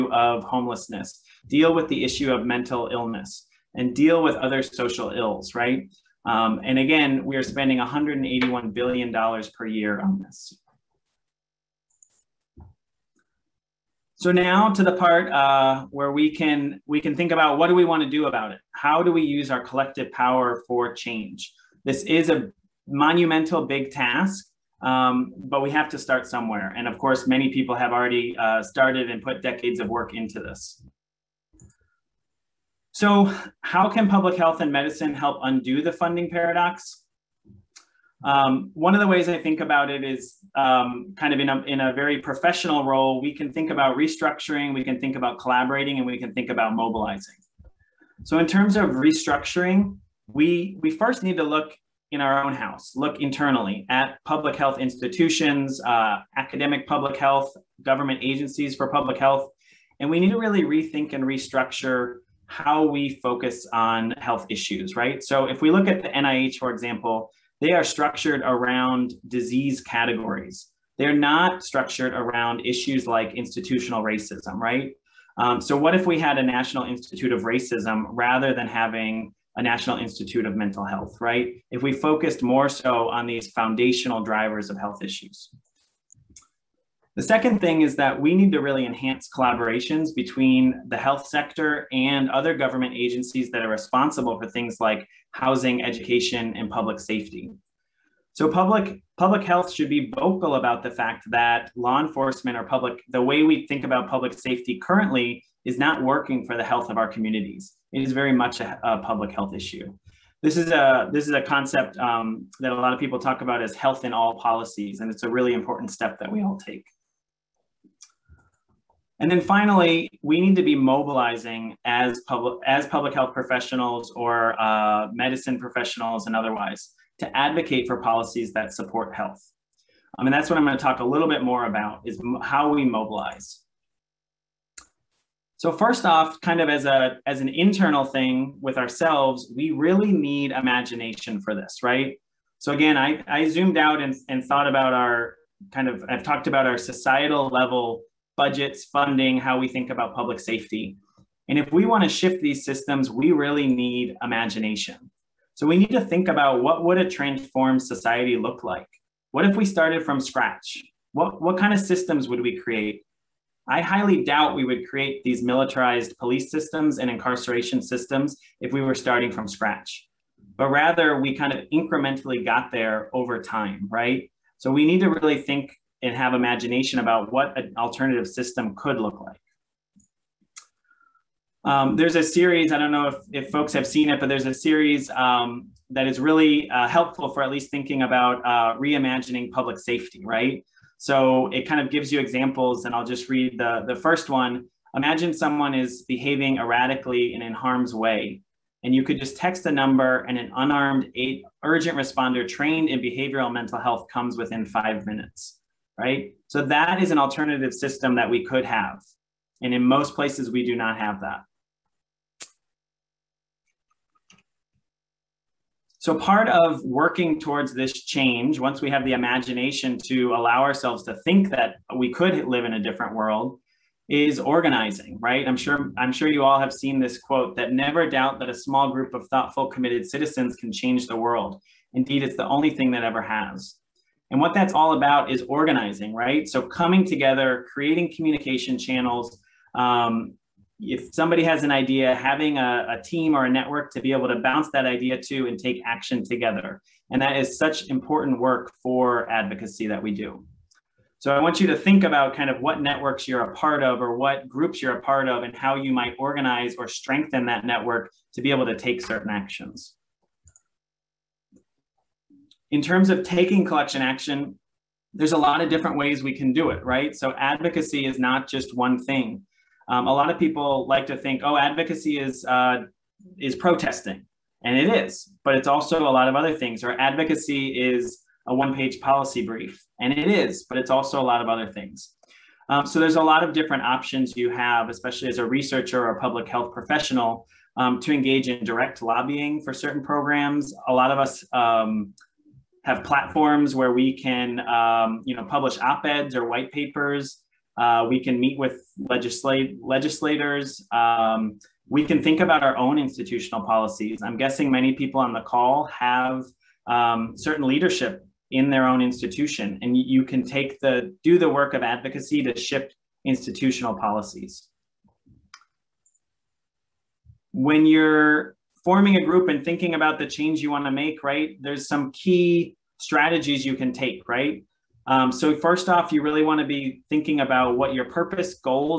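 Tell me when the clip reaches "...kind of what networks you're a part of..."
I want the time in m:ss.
4:12.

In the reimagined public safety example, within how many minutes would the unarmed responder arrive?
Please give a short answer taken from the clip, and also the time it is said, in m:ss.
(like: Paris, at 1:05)
5 minutes, at 3:24.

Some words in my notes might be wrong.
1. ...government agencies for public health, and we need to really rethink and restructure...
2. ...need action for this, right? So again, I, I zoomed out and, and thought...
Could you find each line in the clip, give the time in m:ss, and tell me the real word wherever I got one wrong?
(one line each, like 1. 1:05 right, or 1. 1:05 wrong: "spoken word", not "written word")
1. 0:57 right
2. 2:20 wrong: "imagination", not "action".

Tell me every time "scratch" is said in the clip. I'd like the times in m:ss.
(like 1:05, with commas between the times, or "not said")
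2:40, 2:49.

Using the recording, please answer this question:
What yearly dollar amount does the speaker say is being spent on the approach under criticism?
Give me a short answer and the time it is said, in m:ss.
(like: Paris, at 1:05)
$181 billion, at 0:07.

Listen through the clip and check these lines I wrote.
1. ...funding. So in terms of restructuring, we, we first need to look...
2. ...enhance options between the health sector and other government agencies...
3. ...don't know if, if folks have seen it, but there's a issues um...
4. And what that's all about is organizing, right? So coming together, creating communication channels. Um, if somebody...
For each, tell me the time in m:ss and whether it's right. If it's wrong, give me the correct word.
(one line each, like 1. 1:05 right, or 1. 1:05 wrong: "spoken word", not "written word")
1. 0:46 wrong: "mobilizing", not "funding"
2. 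1:28 wrong: "collaborations", not "options"
3. 3:02 wrong: "series", not "issues"
4. 3:54 right.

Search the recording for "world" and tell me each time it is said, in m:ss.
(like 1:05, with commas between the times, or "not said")
3:43, 3:51.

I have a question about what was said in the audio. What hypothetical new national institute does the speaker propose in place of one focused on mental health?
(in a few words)
National Institute of Racism.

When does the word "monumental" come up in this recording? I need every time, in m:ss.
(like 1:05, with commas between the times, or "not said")
0:22.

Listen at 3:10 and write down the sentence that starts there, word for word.
So it kind of gives you examples, and I'll just read the, the first one.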